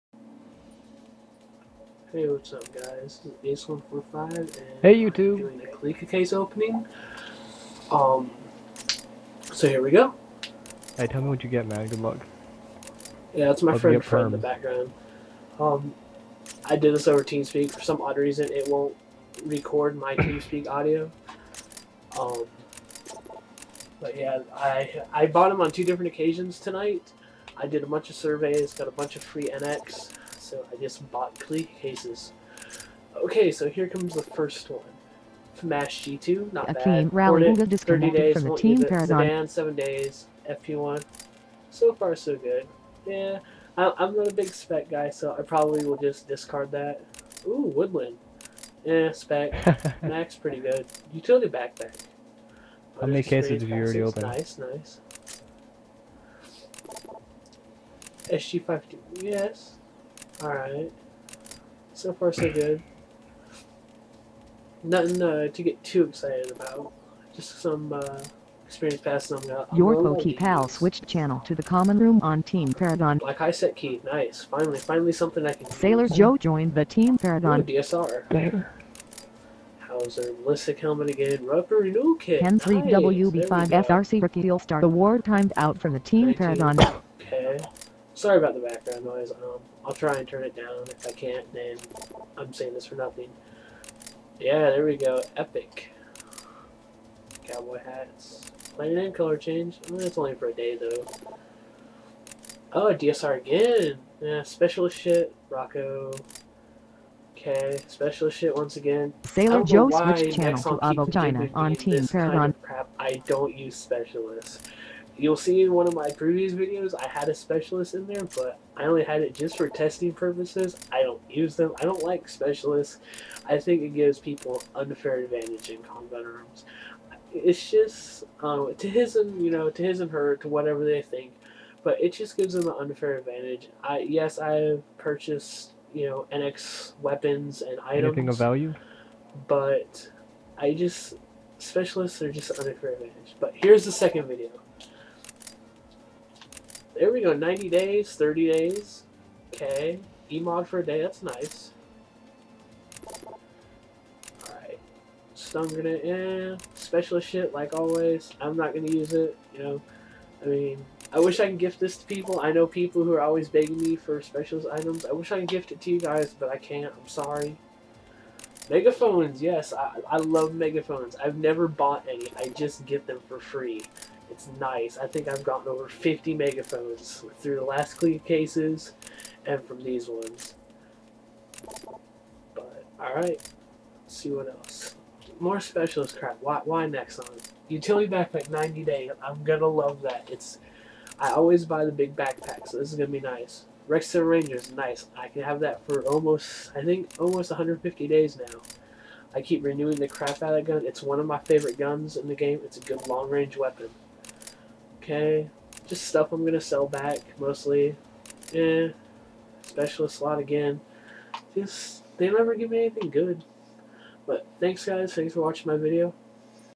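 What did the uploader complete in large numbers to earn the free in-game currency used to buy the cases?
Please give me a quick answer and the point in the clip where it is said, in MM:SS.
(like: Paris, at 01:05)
Surveys, at 00:28.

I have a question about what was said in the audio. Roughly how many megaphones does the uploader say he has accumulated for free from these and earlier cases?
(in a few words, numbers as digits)
Over 50.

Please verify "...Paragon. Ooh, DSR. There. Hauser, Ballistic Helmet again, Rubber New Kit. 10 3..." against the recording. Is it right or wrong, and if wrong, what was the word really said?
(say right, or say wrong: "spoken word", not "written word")
right.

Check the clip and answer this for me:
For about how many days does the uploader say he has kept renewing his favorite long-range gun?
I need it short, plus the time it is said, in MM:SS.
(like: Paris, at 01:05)
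150, at 03:17.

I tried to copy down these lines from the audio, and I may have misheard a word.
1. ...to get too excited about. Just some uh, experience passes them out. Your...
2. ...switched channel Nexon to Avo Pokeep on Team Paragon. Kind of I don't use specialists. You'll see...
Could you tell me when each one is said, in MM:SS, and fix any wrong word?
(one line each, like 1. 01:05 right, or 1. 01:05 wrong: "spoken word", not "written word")
1. 01:05 right
2. 01:49 wrong: "China", not "Pokeep".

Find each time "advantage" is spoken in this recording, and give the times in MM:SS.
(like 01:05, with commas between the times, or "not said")
02:05, 02:13, 02:22.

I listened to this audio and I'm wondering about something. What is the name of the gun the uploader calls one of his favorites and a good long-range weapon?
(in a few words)
Rex Rangers.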